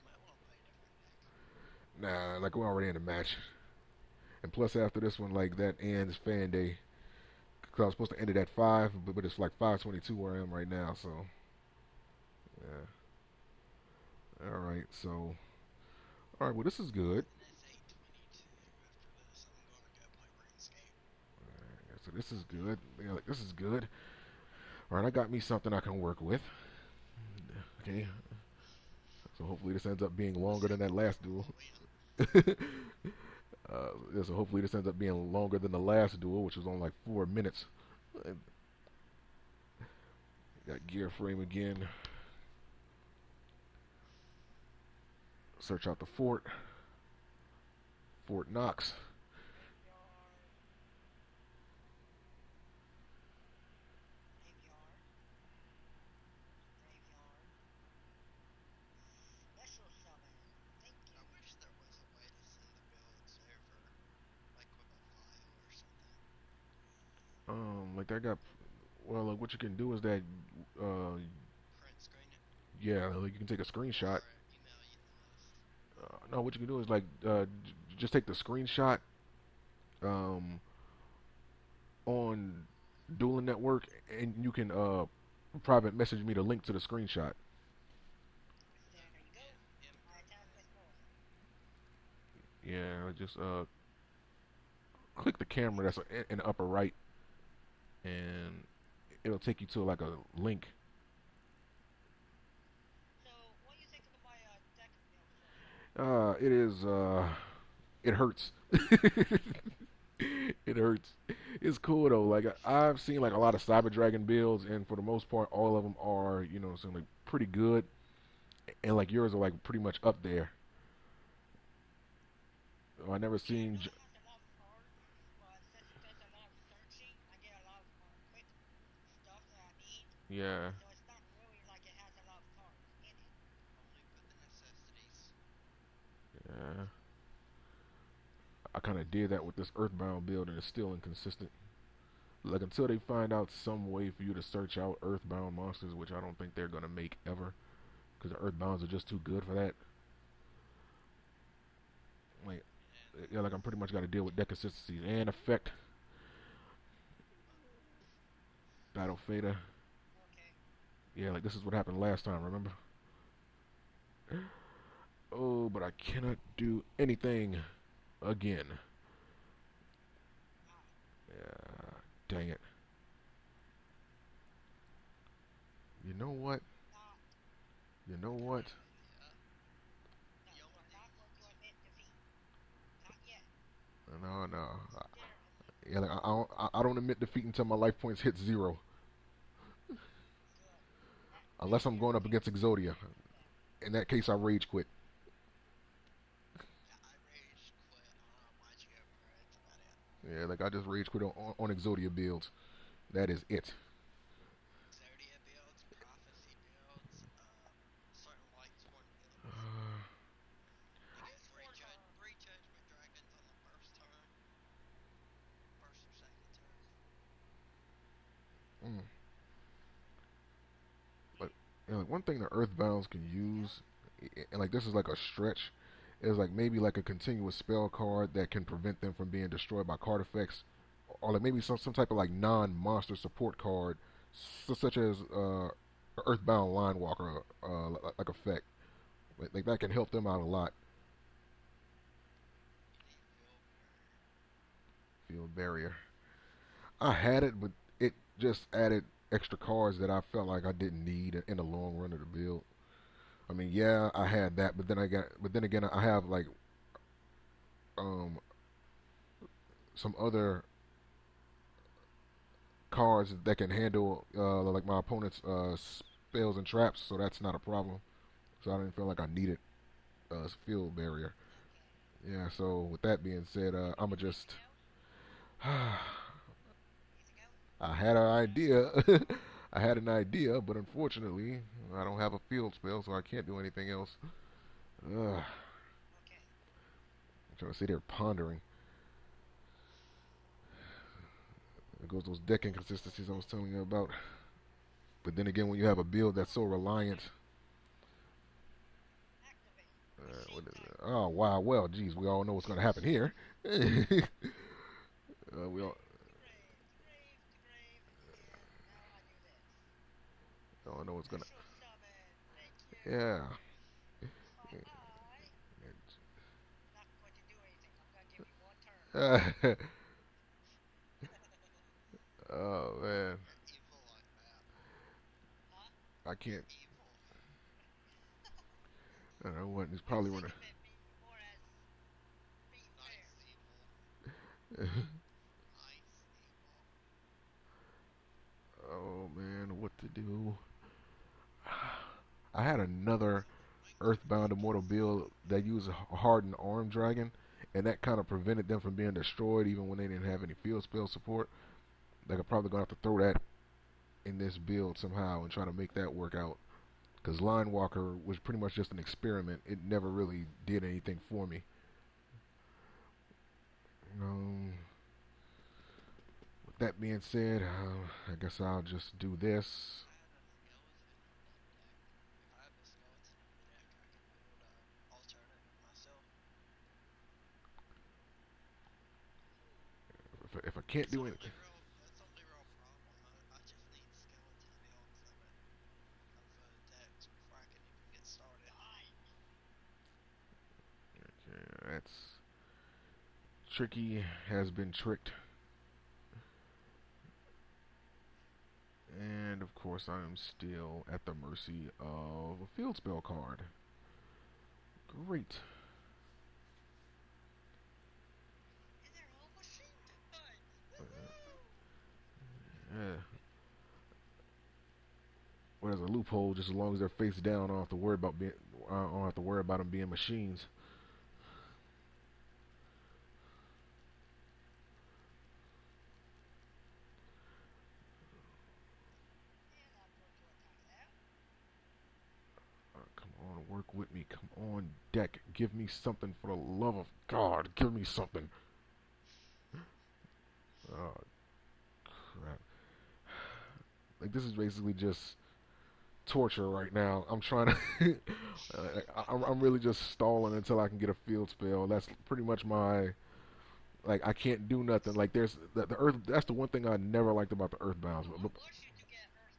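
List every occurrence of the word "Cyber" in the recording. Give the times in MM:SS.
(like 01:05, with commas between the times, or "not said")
01:53.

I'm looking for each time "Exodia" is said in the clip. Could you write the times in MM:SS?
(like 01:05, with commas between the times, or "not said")
03:12, 03:21.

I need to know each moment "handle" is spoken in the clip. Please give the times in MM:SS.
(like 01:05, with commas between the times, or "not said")
04:23.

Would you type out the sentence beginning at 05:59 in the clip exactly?
It never really did anything for me.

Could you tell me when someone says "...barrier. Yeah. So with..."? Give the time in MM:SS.
04:30.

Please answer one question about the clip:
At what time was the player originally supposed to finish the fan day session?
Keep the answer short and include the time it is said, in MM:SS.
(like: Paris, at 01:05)
5, at 00:08.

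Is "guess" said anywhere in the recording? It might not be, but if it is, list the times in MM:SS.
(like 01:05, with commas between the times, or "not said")
06:08.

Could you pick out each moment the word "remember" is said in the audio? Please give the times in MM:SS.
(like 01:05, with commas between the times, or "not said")
02:42.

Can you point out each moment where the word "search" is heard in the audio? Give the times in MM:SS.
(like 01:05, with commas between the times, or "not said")
00:45, 02:24.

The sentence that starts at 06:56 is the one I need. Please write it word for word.
Just as long as they're face down, I don't have to worry about being.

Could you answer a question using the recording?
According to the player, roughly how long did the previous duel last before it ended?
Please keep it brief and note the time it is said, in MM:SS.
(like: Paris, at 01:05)
4 minutes, at 00:37.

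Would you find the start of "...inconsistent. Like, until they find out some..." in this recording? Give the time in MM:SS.
02:20.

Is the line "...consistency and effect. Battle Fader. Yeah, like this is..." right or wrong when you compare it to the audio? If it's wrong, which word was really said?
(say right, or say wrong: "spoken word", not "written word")
right.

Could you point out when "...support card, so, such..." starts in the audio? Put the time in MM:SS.
03:53.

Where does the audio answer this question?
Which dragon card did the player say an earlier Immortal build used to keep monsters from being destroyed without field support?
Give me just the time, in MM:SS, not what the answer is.
05:46.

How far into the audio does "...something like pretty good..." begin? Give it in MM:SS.
01:56.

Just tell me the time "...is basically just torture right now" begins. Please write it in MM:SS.
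07:24.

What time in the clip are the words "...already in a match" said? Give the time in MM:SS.
00:02.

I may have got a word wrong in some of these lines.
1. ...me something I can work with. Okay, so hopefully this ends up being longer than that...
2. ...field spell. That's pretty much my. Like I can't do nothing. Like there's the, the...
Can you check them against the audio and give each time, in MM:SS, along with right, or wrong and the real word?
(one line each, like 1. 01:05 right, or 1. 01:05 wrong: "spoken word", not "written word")
1. 00:25 right
2. 07:31 right.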